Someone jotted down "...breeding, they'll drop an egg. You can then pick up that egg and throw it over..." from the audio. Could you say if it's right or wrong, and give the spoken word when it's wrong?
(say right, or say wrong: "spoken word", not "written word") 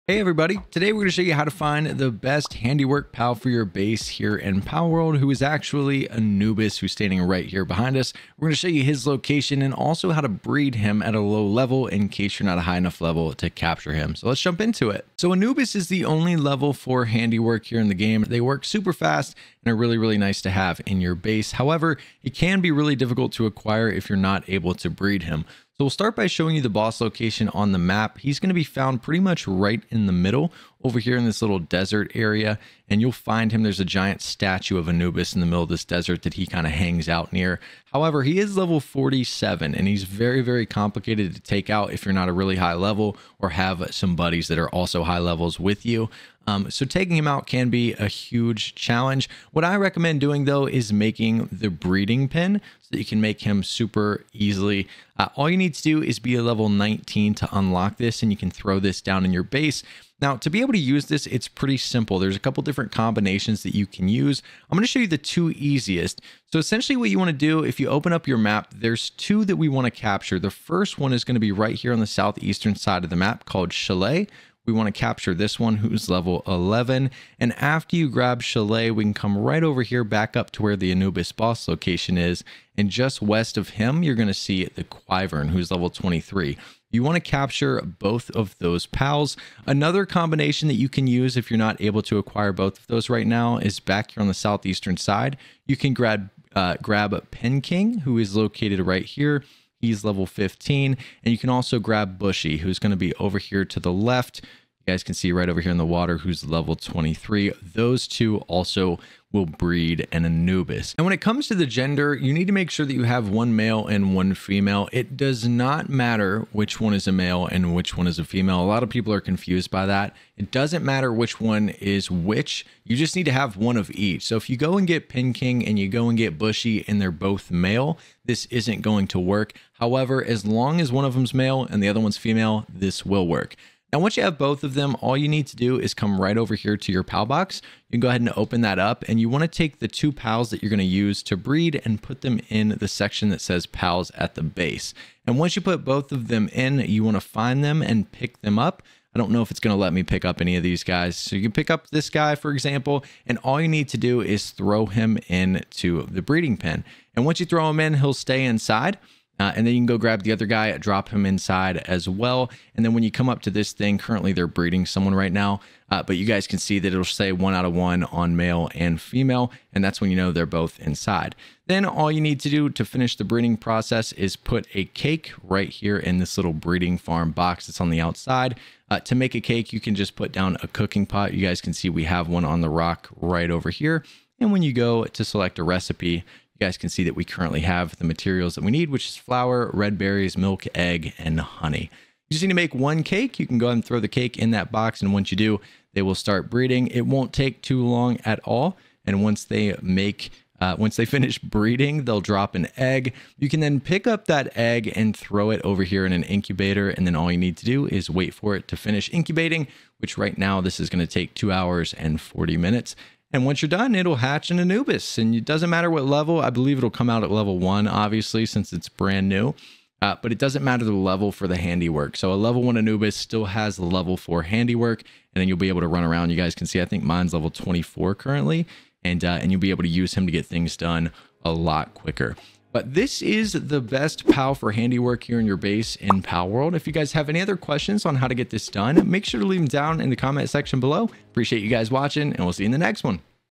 right.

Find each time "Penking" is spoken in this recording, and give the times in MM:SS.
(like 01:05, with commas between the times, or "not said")
01:37, 02:05.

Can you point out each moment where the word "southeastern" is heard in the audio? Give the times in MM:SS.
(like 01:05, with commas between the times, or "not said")
01:12, 01:34.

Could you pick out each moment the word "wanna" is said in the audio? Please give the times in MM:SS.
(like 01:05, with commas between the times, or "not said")
02:19, 02:27.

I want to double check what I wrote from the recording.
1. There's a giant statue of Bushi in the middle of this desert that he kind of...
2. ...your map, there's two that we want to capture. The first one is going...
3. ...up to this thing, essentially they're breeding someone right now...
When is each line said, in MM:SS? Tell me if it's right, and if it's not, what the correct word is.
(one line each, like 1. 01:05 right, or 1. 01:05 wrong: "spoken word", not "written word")
1. 00:33 wrong: "Anubis", not "Bushi"
2. 01:08 right
3. 02:43 wrong: "currently", not "essentially".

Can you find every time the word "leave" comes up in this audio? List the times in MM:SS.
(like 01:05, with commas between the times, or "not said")
03:59.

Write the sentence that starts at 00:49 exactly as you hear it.
What I recommend doing though is making the breeding pen that you can make him super easily.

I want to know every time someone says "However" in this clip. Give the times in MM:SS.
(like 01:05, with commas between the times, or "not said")
00:21, 00:37, 02:09.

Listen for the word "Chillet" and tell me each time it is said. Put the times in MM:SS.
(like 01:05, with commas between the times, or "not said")
01:13, 01:18.